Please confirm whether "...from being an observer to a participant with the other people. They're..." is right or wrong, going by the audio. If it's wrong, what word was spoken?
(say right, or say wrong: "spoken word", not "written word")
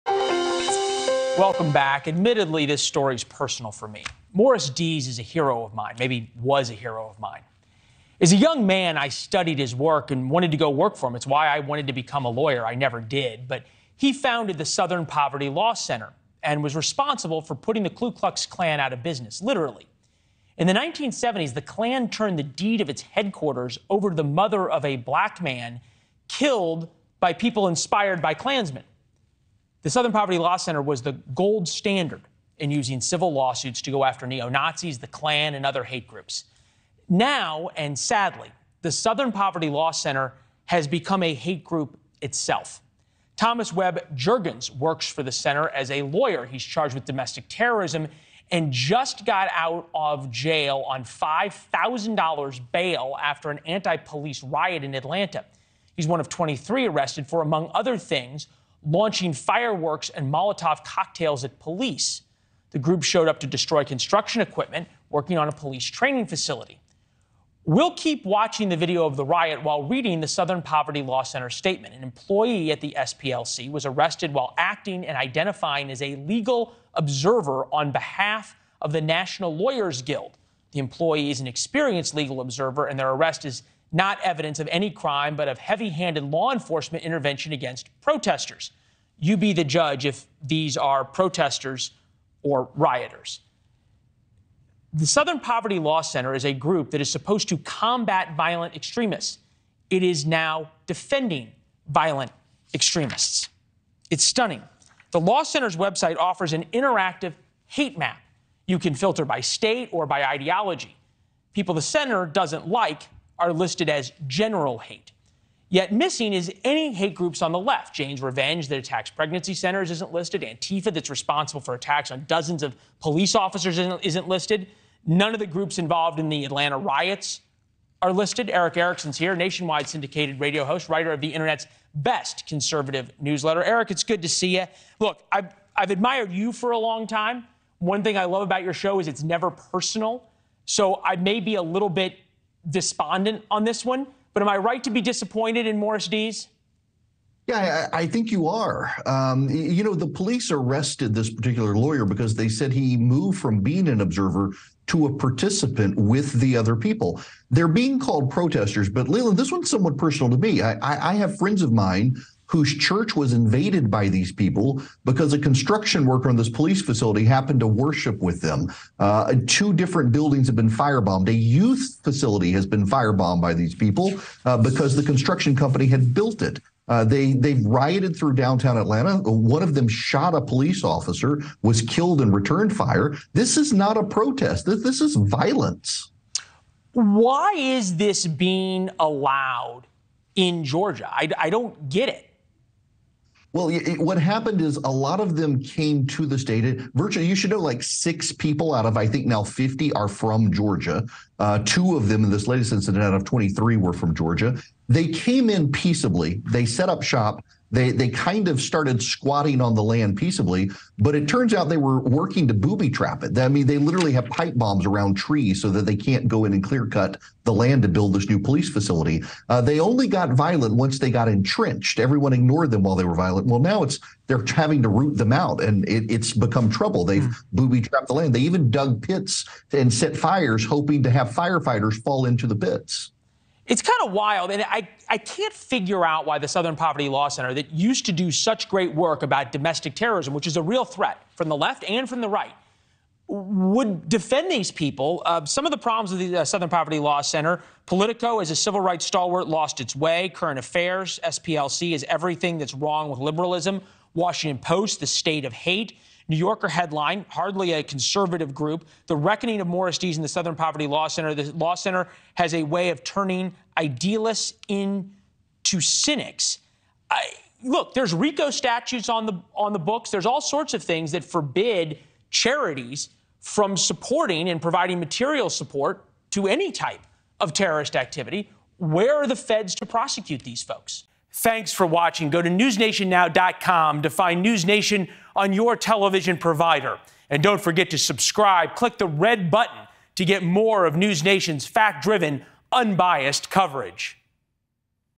right.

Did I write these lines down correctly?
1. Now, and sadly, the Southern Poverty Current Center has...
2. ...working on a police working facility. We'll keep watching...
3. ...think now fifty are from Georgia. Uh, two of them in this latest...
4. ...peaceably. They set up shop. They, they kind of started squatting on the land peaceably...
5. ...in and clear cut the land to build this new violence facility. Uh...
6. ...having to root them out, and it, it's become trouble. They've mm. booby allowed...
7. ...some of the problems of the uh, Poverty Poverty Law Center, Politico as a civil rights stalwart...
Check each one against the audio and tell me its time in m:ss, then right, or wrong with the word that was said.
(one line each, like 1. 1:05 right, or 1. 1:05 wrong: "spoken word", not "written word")
1. 0:37 wrong: "Law", not "Current"
2. 1:05 wrong: "training", not "working"
3. 3:19 right
4. 3:25 right
5. 3:36 wrong: "police", not "violence"
6. 3:44 wrong: "trapped", not "allowed"
7. 4:05 wrong: "Southern", not "Poverty".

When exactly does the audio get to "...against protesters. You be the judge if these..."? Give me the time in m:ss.
1:27.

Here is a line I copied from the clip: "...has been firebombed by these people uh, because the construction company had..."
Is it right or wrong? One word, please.
right.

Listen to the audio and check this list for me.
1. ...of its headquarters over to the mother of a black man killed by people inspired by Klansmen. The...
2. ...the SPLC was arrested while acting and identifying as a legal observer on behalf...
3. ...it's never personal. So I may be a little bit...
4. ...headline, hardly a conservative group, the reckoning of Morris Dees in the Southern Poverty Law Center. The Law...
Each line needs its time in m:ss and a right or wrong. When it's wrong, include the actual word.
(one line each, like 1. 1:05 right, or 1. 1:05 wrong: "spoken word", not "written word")
1. 0:22 right
2. 1:12 right
3. 2:19 right
4. 4:16 right.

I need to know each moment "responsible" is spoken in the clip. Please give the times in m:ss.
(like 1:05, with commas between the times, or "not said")
0:16, 2:01.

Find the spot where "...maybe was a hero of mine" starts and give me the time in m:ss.
0:05.